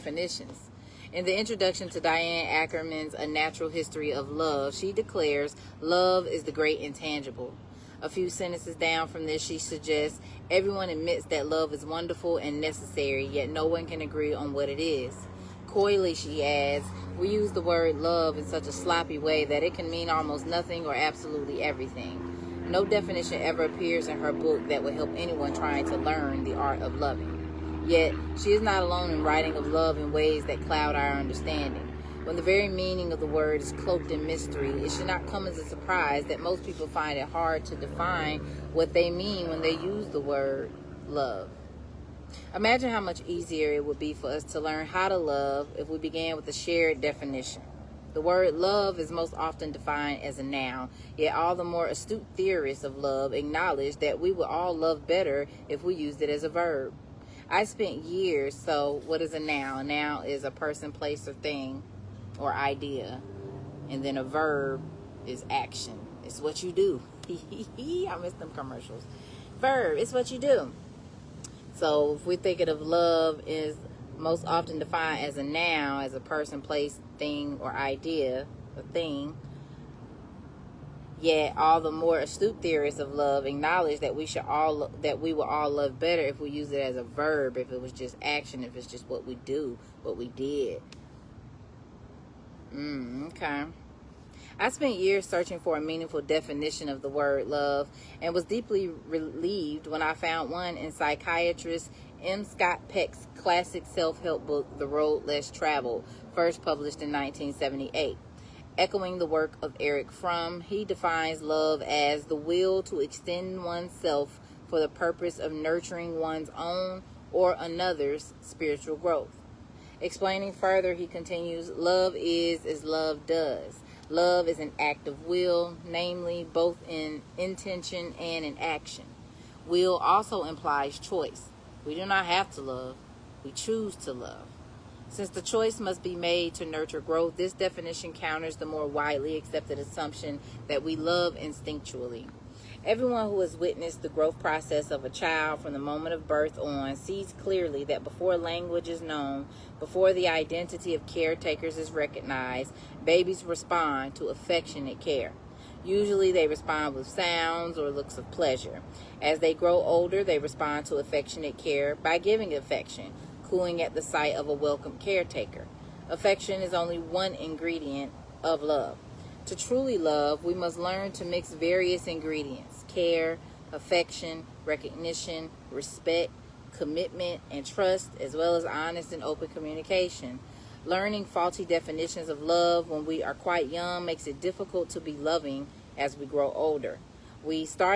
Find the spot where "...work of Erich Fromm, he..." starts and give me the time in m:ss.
1:49.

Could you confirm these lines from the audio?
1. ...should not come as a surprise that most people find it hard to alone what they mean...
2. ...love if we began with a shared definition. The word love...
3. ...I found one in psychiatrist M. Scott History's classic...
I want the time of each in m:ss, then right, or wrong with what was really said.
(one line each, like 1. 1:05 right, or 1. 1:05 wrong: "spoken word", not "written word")
1. 0:34 wrong: "define", not "alone"
2. 0:45 right
3. 1:40 wrong: "Peck", not "History".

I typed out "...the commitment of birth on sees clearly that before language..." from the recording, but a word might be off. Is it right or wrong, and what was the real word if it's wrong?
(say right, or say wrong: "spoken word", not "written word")
wrong: "moment", not "commitment".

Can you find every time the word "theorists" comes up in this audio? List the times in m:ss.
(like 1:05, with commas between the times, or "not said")
0:52, 1:22.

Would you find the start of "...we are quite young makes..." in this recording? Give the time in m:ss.
3:03.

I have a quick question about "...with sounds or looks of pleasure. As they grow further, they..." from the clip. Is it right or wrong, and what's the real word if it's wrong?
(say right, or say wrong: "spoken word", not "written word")
wrong: "older", not "further".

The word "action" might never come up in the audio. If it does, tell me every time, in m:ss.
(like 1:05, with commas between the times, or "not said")
1:05, 1:28, 2:08.